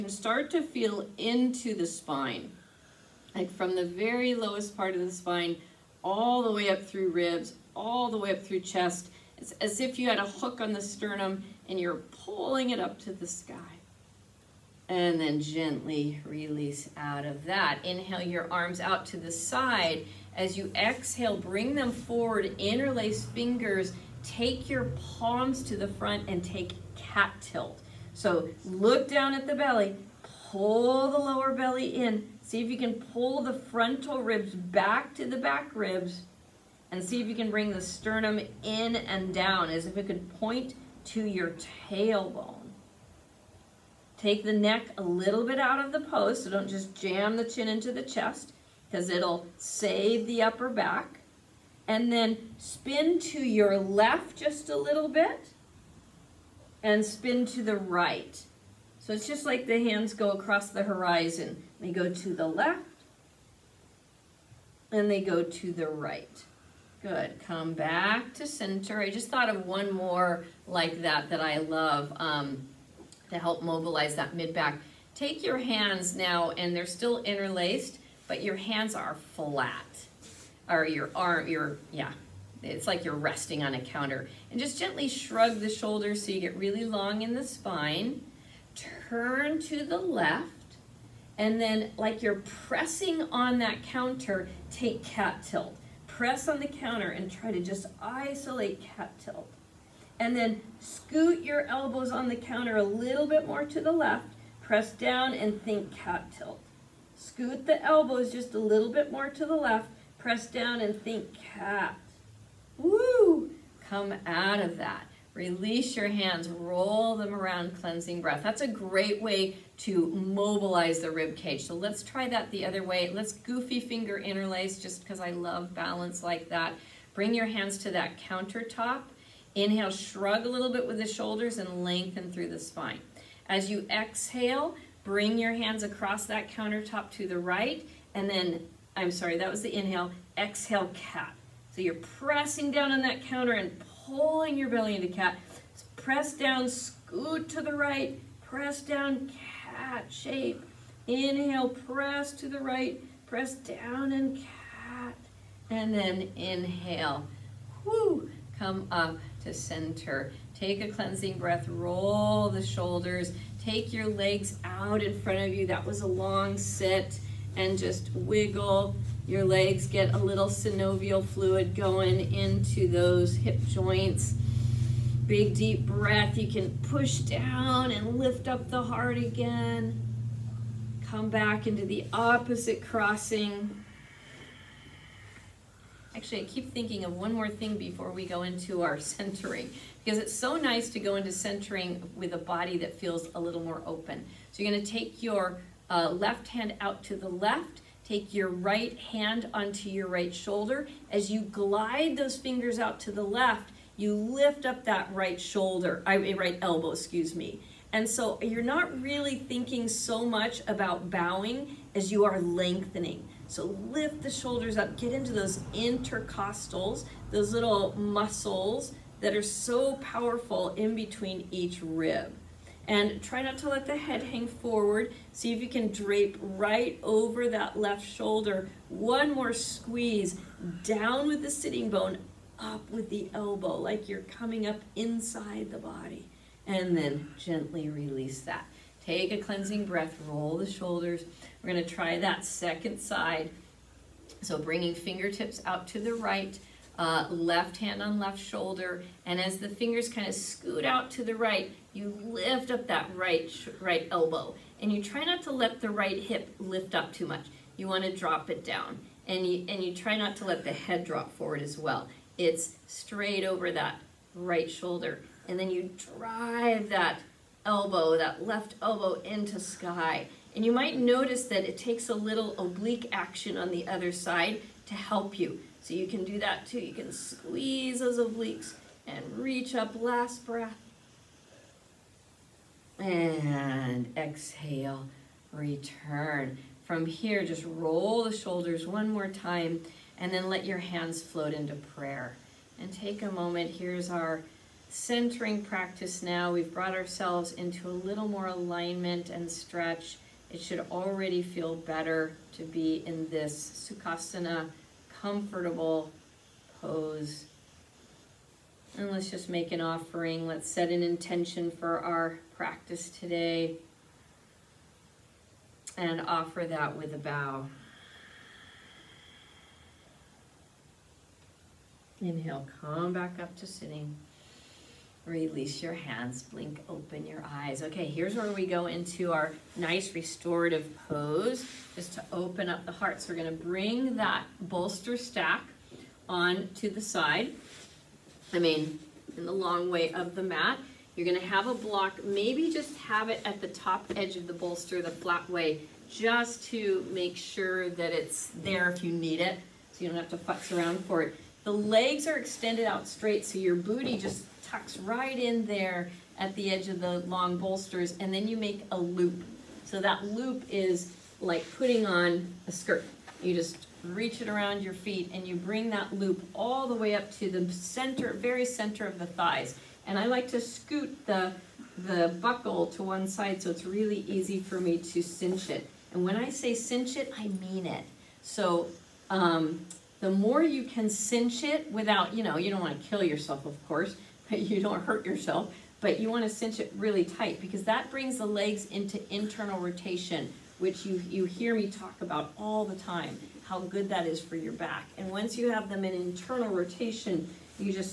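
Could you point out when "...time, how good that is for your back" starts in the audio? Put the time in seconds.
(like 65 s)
392 s.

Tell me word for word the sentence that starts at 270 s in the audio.
And you might notice that it takes a little oblique action on the other side to help you.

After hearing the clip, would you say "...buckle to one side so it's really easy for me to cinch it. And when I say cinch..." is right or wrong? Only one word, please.
right.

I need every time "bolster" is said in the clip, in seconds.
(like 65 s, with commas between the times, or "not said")
334 s, 344 s, 357 s.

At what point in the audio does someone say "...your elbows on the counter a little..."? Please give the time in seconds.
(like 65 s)
101 s.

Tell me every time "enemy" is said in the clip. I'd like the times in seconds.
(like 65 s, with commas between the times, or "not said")
not said.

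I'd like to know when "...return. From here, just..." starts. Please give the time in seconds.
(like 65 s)
285 s.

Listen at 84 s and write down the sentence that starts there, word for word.
And just gently shrug the shoulders so you get really long in the spine.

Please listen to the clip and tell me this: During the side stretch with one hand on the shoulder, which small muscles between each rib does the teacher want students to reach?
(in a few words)
Intercostals.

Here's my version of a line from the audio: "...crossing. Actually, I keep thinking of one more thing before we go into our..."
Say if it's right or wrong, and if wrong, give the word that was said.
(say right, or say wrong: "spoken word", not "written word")
right.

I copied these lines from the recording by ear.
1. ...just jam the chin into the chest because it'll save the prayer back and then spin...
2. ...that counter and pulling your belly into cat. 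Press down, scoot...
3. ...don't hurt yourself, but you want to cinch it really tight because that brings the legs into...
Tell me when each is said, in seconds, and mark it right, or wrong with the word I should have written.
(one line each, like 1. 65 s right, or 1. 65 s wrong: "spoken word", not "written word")
1. 46 s wrong: "upper", not "prayer"
2. 143 s right
3. 384 s right.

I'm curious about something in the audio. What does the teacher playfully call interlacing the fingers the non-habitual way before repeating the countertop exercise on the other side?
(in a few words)
Goofy finger interlace.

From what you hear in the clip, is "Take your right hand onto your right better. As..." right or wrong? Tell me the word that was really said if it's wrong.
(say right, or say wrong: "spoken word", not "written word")
wrong: "shoulder", not "better".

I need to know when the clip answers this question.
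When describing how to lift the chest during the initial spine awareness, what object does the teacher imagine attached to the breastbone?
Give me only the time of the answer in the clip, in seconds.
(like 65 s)
10 s.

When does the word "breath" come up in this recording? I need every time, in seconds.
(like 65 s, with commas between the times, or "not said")
118 s, 161 s, 175 s, 239 s, 280 s.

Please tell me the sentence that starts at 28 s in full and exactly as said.
So look down at the belly, pull the lower belly in.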